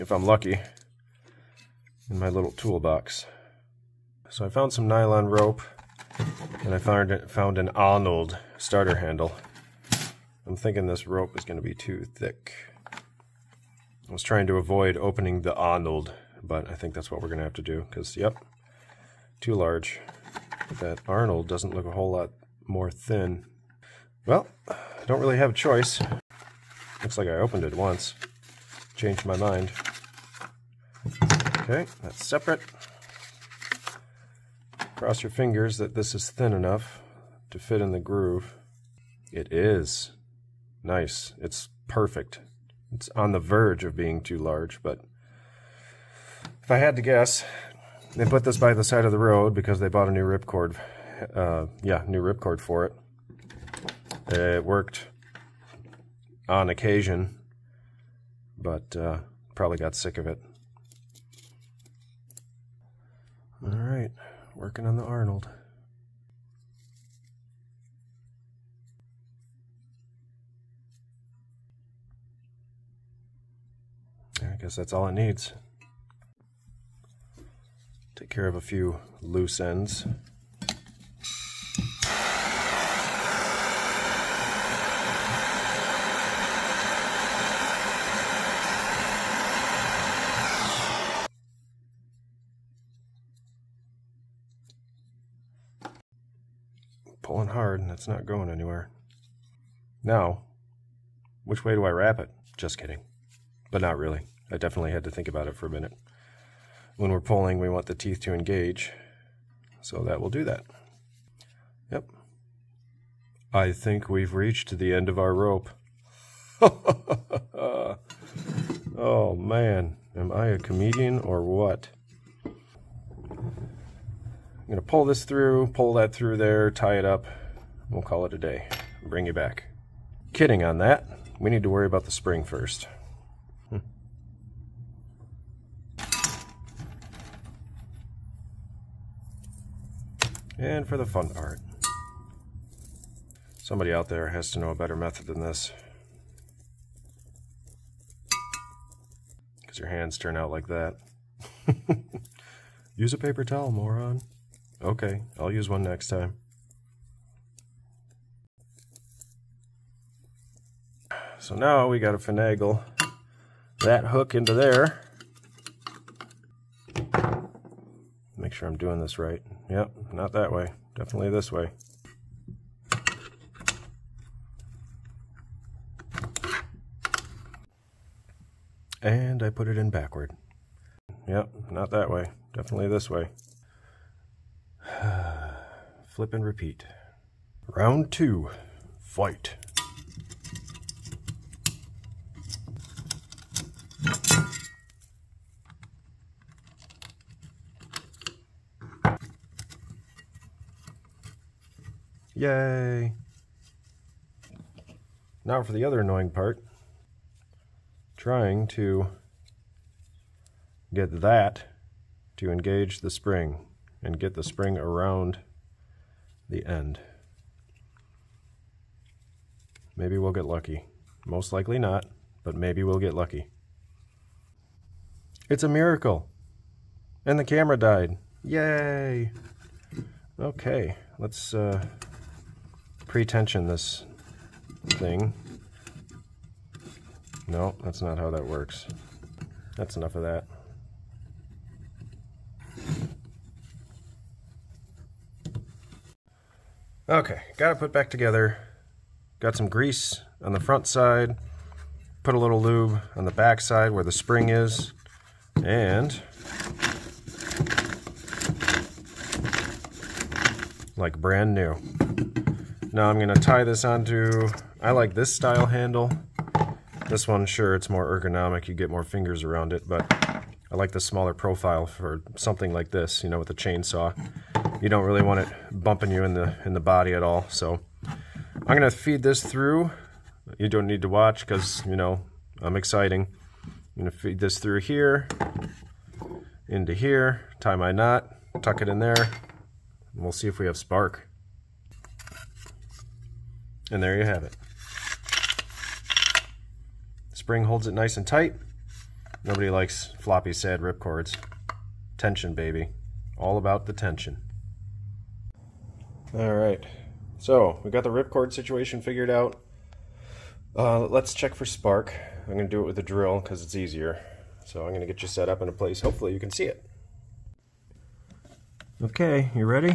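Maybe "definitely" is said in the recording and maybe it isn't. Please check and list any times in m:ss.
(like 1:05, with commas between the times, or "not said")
1:44, 2:50, 3:02.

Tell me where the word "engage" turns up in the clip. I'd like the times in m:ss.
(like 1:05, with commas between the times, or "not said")
1:48, 3:32.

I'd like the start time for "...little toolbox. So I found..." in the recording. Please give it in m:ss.
0:02.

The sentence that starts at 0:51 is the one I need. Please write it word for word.
Uh, yeah, new ripcord for it.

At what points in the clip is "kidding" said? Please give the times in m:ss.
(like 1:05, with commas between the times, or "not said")
1:42, 2:10.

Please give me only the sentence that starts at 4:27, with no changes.
This one, sure, it's more ergonomic.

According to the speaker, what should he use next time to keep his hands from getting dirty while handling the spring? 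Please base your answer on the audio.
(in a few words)
a paper towel.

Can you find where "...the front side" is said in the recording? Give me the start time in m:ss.
4:10.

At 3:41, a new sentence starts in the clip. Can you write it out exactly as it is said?
Most likely not, but maybe we'll get lucky.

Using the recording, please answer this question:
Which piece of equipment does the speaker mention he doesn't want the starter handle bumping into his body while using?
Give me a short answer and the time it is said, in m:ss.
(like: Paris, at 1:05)
chainsaw, at 4:33.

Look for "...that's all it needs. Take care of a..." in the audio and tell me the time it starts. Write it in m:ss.
1:14.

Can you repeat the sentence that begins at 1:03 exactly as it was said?
All right, working on the Arnold.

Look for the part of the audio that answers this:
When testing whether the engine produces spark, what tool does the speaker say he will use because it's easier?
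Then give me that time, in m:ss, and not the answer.
5:13.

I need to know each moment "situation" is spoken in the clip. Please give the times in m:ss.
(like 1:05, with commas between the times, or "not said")
5:08.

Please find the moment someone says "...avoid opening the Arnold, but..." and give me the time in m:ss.
0:14.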